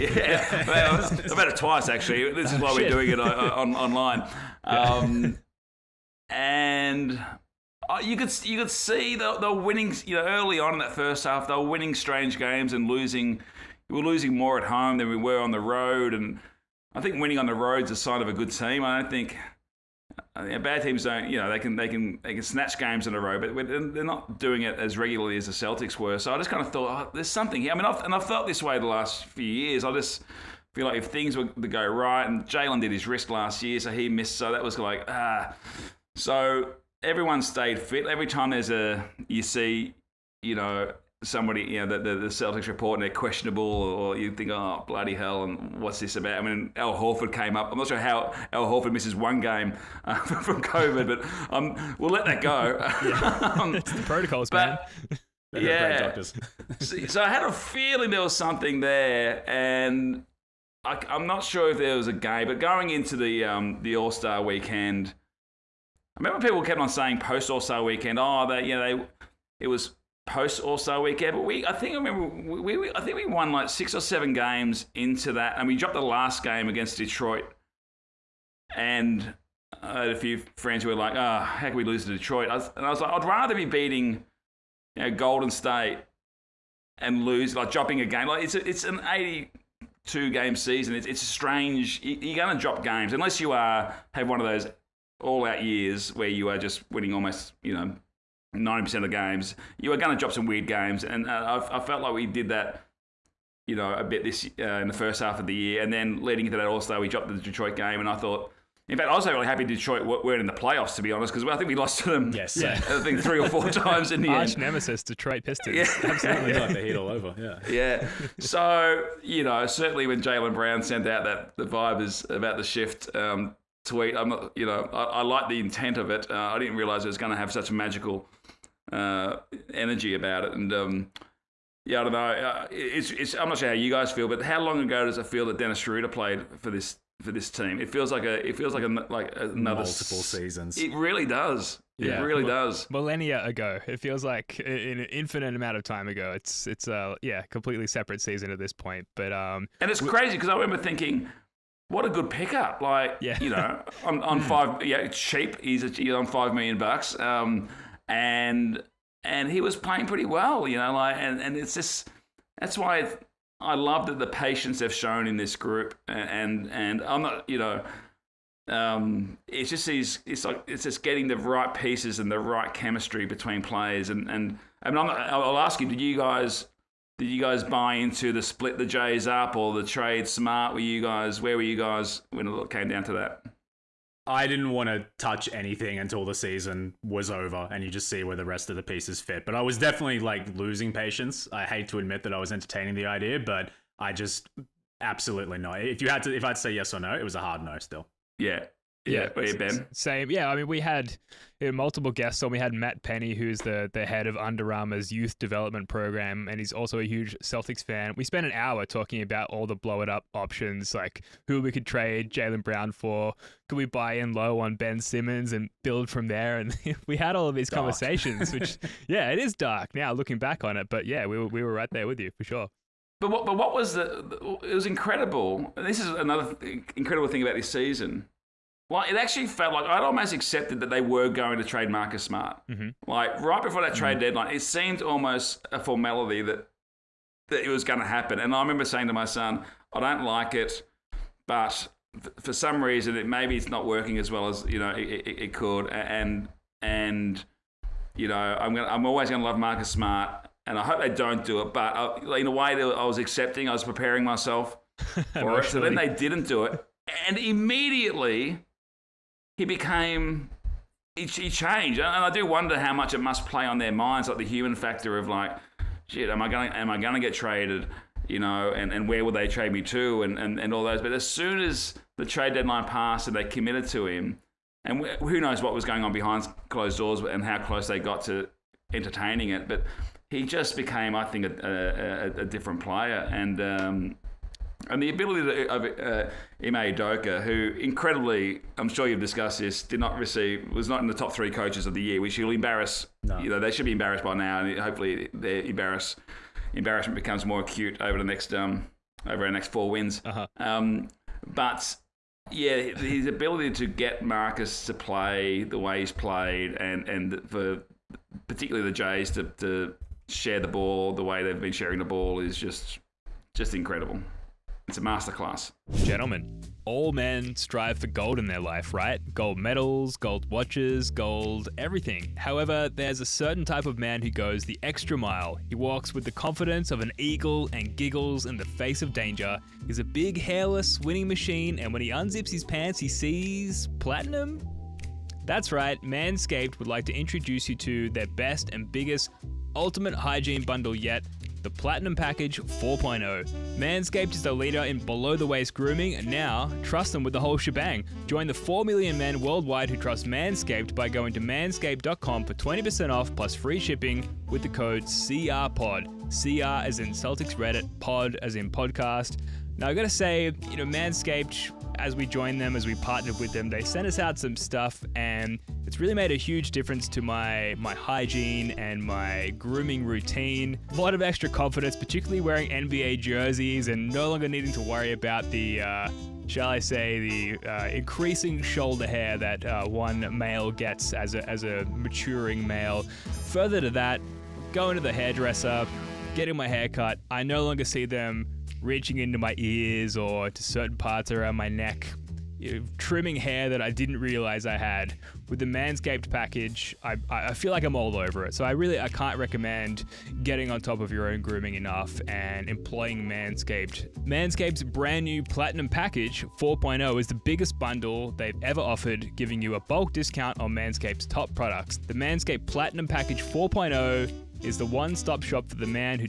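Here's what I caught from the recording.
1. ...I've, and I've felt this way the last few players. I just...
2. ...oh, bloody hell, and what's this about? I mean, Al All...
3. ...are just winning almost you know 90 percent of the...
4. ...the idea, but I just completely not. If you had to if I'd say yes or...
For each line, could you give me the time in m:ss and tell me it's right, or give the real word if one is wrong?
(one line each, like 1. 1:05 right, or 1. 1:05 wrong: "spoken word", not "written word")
1. 0:27 wrong: "years", not "players"
2. 0:44 wrong: "Horford", not "All"
3. 1:36 right
4. 3:12 wrong: "absolutely", not "completely".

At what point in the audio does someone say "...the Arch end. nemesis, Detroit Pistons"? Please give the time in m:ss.
1:54.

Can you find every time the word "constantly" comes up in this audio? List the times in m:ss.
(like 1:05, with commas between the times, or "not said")
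not said.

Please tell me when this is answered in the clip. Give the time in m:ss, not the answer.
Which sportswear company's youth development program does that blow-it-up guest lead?
3:24.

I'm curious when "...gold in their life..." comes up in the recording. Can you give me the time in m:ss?
5:18.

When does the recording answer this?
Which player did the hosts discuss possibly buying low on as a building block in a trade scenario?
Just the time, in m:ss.
3:34.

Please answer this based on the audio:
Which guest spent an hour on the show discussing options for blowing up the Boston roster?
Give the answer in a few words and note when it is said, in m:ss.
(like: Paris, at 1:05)
Matt Penny, at 3:22.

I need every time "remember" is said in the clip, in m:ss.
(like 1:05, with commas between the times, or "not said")
1:06, 1:11, 2:30, 3:58.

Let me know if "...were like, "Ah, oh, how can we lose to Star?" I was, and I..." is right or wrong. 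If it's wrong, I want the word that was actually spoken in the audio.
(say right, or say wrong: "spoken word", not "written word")
wrong: "Detroit", not "Star".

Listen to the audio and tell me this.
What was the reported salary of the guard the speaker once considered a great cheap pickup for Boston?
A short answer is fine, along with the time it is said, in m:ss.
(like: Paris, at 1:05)
5 million, at 2:36.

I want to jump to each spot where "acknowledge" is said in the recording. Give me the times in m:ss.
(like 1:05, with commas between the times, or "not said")
not said.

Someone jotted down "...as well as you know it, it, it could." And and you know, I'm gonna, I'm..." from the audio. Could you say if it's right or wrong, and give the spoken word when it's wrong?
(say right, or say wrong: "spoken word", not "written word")
right.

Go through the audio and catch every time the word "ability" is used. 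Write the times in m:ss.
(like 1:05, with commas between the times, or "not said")
4:45, 5:03.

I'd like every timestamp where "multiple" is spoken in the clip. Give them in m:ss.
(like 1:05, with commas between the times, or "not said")
2:19, 3:21.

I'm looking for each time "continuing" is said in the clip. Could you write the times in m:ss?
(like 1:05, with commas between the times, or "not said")
not said.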